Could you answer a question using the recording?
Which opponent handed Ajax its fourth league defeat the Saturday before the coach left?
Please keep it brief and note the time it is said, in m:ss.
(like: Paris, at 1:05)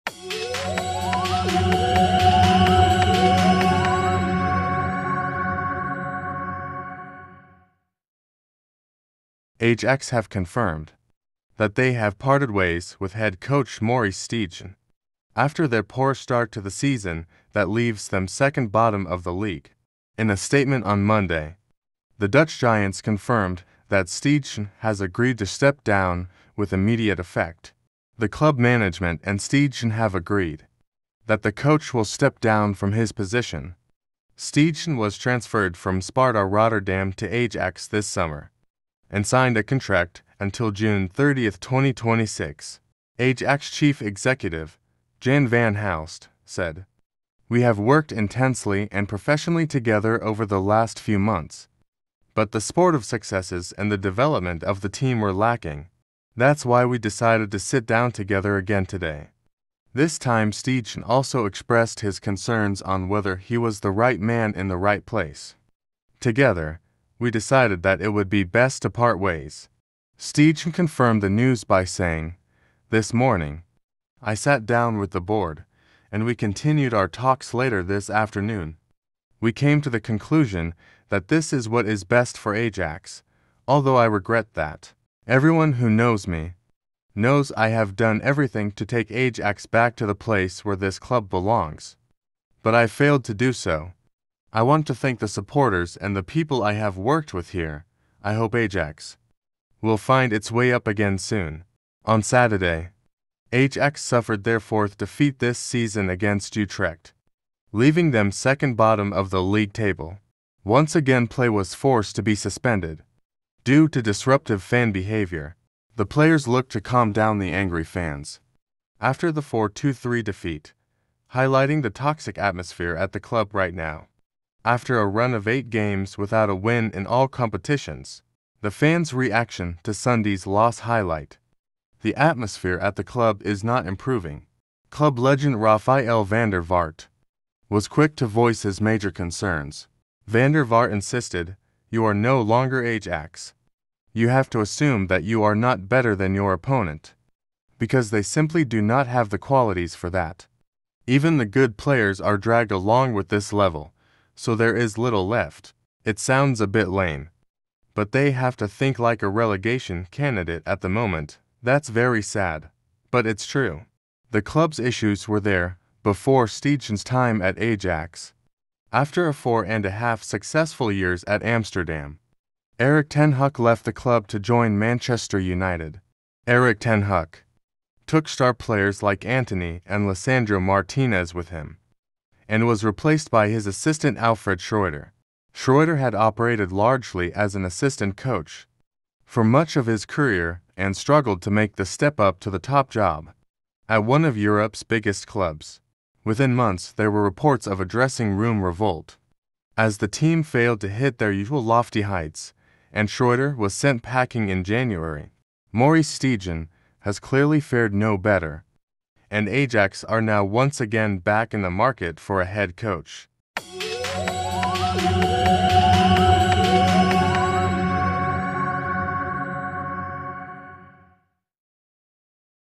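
Utrecht, at 1:46.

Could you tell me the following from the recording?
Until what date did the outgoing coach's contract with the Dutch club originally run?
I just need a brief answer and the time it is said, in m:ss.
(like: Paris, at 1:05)
June 30, 2026, at 0:40.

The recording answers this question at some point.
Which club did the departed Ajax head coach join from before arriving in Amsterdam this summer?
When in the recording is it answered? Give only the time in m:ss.
0:36.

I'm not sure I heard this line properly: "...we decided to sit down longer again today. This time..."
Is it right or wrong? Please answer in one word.
wrong.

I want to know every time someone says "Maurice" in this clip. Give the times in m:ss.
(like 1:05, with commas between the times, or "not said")
0:13, 3:25.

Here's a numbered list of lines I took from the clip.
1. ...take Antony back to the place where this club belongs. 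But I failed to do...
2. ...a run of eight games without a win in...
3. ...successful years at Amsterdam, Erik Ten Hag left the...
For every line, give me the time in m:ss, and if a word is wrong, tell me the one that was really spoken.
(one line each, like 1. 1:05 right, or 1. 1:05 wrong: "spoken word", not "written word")
1. 1:28 wrong: "Ajax", not "Antony"
2. 2:04 right
3. 2:50 right.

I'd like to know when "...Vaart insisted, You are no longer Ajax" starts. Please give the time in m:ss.
2:20.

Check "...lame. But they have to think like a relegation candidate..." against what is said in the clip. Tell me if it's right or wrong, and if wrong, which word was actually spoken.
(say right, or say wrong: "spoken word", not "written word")
right.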